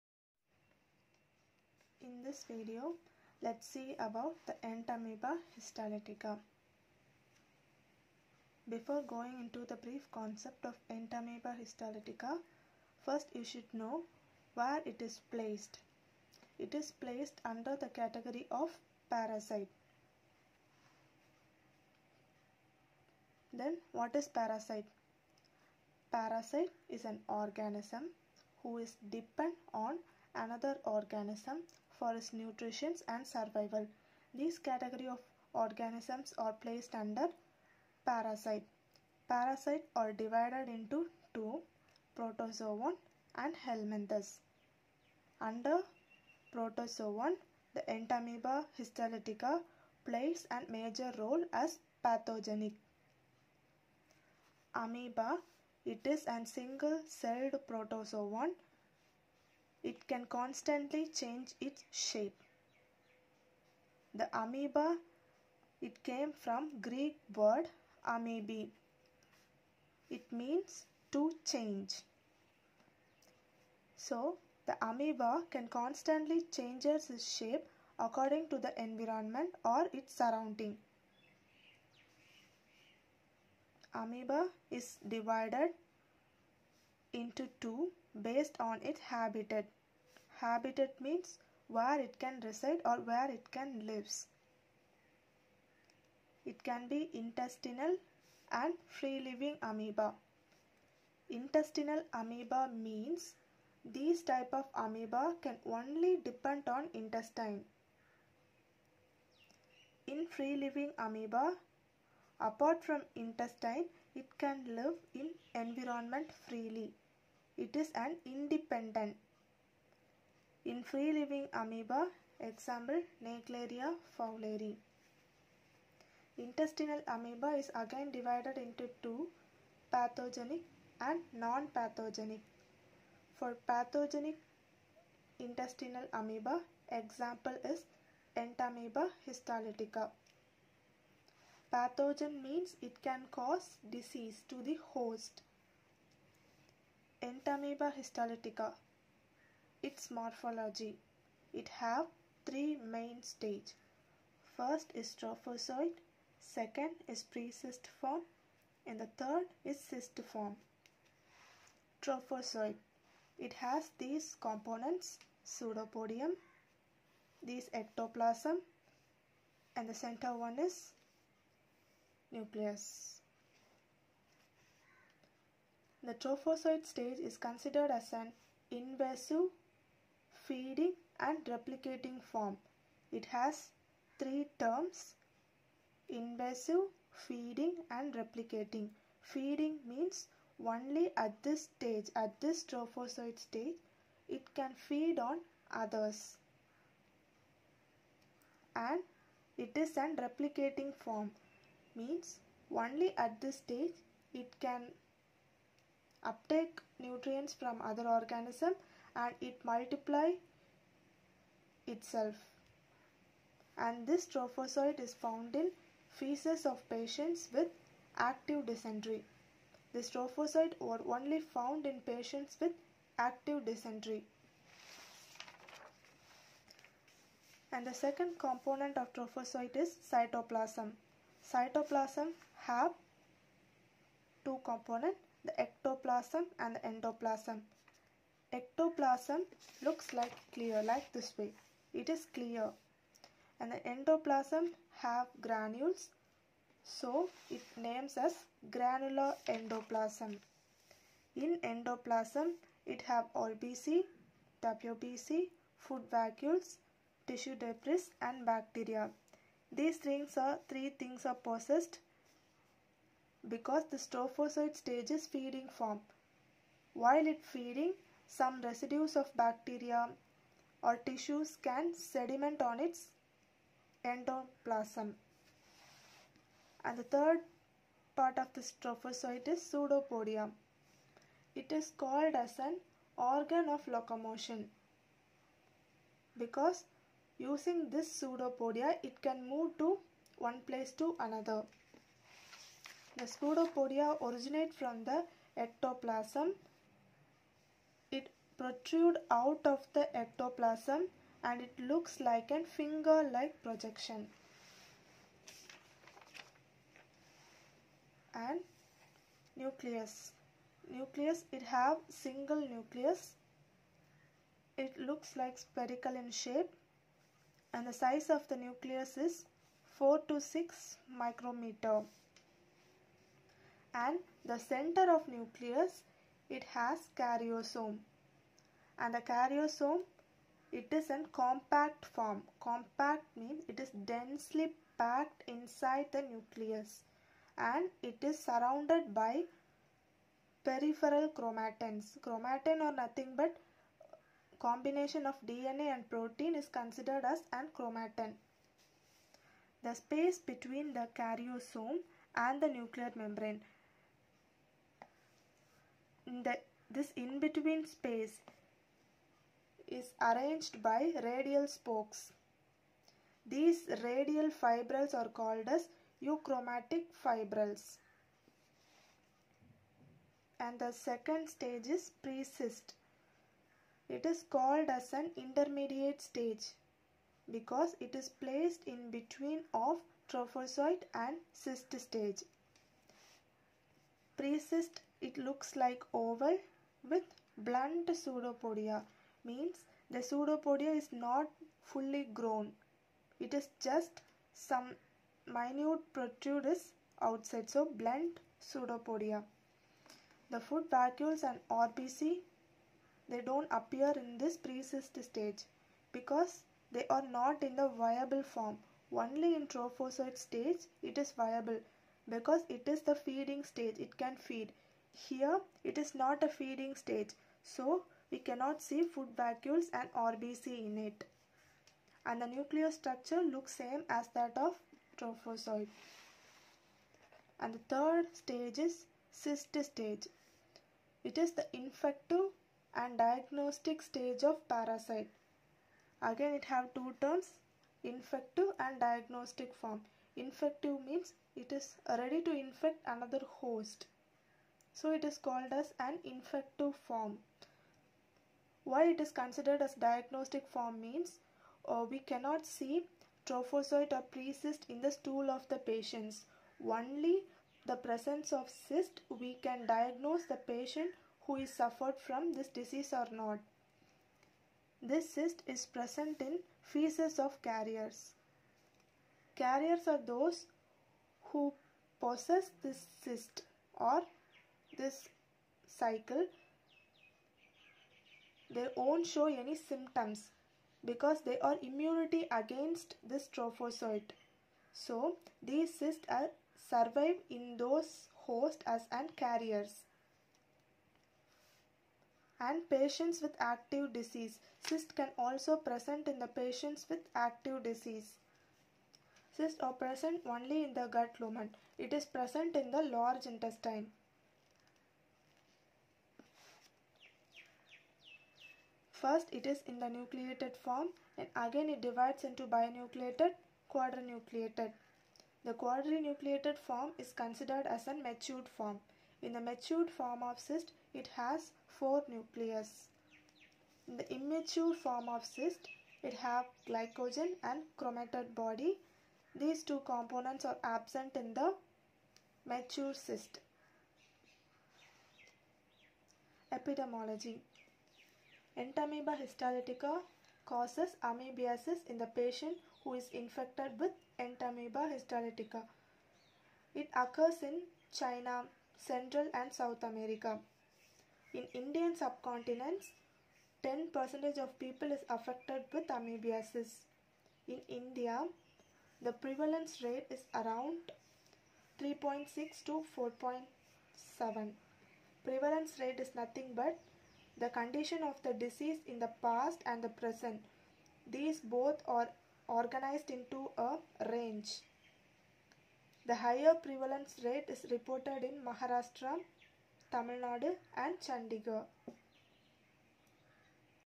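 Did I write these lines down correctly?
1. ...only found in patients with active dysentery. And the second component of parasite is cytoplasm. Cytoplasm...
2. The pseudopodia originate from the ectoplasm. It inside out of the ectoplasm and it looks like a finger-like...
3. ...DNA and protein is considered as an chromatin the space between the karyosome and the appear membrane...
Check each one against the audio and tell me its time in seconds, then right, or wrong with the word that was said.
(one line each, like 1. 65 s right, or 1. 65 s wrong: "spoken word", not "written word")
1. 221 s wrong: "trophozoite", not "parasite"
2. 293 s wrong: "protrude", not "inside"
3. 345 s wrong: "nuclear", not "appear".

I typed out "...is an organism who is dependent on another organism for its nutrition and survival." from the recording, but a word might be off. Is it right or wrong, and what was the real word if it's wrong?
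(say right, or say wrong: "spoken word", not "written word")
right.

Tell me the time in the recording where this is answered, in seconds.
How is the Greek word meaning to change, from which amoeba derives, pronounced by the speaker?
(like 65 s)
68 s.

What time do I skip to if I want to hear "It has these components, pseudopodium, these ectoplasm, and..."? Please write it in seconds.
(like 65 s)
163 s.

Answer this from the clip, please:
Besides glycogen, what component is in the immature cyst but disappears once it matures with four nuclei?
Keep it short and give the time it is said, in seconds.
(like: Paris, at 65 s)
Chromatoid body, at 527 s.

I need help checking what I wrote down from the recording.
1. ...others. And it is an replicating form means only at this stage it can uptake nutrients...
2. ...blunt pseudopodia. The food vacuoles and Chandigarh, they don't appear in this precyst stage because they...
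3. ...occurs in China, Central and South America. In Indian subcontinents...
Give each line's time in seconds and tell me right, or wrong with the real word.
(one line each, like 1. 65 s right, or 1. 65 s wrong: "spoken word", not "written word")
1. 195 s right
2. 397 s wrong: "RBC", not "Chandigarh"
3. 547 s right.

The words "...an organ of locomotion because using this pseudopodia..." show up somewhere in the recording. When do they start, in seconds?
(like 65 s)
282 s.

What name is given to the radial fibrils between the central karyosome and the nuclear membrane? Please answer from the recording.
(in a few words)
Achromatic fibrils.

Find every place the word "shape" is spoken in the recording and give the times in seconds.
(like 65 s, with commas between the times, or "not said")
61 s, 77 s, 316 s.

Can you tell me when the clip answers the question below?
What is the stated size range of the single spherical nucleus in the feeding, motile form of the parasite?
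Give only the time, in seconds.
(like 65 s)
319 s.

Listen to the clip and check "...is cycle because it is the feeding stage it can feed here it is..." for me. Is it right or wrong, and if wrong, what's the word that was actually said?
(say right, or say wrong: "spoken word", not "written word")
wrong: "viable", not "cycle".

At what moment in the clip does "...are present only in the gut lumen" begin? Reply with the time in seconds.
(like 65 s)
499 s.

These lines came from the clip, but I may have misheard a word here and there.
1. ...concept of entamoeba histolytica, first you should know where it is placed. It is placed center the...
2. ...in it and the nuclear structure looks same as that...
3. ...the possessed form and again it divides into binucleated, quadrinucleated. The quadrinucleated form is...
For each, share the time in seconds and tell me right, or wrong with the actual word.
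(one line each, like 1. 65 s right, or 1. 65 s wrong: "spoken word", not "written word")
1. 10 s wrong: "under", not "center"
2. 420 s right
3. 509 s wrong: "nucleated", not "possessed".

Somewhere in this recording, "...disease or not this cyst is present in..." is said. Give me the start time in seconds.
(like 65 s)
462 s.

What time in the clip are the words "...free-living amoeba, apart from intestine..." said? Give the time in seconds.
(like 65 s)
110 s.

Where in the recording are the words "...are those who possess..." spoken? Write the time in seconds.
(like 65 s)
470 s.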